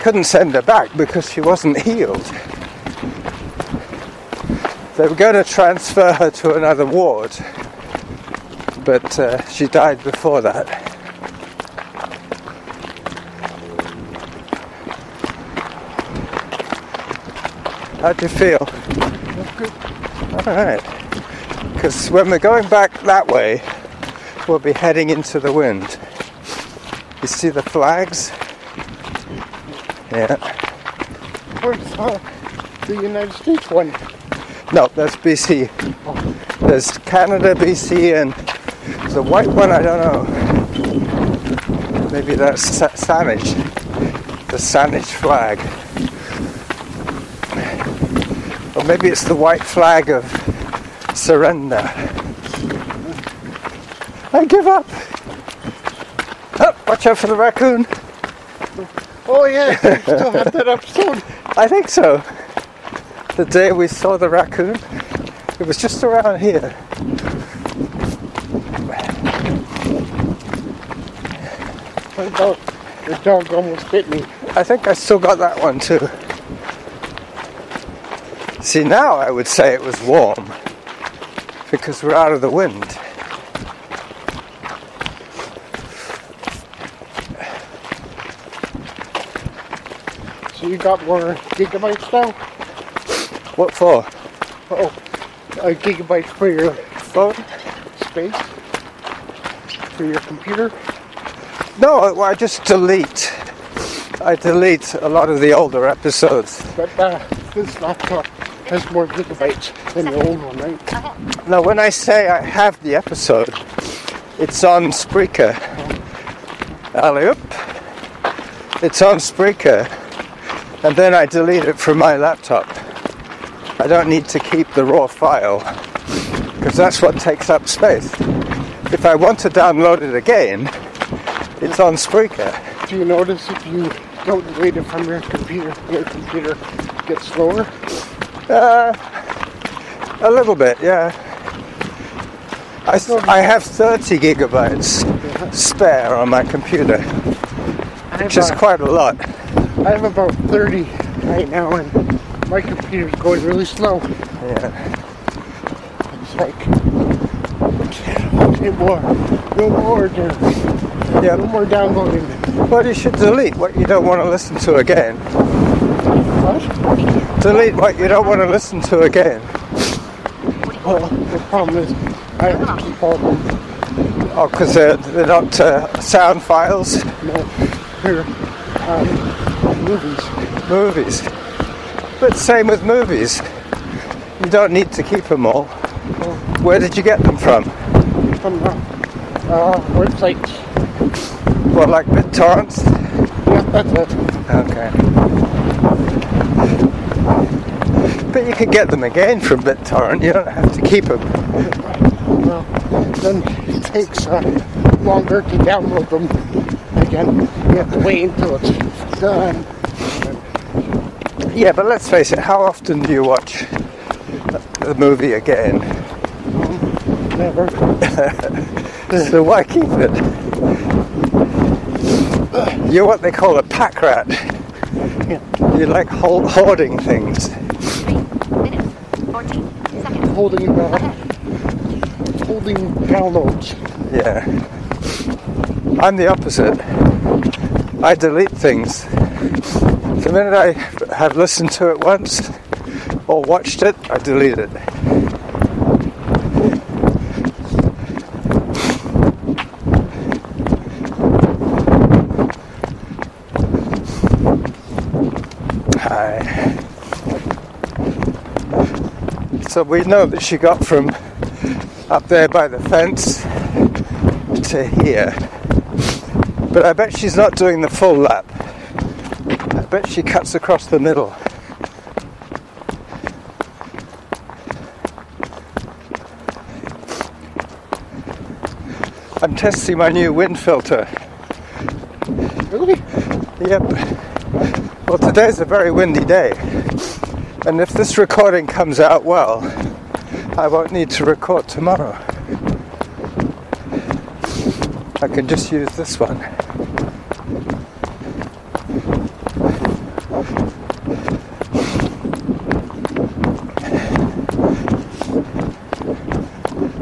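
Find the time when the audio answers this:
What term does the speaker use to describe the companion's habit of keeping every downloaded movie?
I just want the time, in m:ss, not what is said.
3:43.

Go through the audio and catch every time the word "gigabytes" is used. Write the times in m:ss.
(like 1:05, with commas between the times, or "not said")
1:31, 1:35, 1:49, 2:24.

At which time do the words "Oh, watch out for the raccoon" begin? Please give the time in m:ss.
0:56.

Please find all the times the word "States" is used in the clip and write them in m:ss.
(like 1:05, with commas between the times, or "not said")
0:33.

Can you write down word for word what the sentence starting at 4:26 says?
But I bet she's not doing the full lap.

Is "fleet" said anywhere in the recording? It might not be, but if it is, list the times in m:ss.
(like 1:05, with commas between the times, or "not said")
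not said.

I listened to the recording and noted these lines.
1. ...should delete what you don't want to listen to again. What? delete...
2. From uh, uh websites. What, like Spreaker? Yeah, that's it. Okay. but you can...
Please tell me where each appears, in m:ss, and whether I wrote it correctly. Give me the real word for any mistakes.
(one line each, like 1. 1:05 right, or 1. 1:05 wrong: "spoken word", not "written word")
1. 2:42 right
2. 3:08 wrong: "BitTorrents", not "Spreaker".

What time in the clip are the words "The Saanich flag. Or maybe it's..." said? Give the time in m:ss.
0:44.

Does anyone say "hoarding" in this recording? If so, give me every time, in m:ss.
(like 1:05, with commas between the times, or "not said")
3:46.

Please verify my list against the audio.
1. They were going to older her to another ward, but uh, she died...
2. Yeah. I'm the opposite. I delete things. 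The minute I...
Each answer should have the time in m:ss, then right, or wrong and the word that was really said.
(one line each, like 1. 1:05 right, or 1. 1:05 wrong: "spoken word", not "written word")
1. 0:04 wrong: "transfer", not "older"
2. 3:54 right.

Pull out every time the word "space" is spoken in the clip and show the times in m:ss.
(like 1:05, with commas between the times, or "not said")
1:38, 2:07.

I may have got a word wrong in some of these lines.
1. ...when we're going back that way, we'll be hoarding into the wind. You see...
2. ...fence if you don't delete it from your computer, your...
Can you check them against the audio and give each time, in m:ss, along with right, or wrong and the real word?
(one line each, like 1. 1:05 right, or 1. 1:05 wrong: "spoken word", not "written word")
1. 0:22 wrong: "heading", not "hoarding"
2. 2:13 wrong: "notice", not "fence".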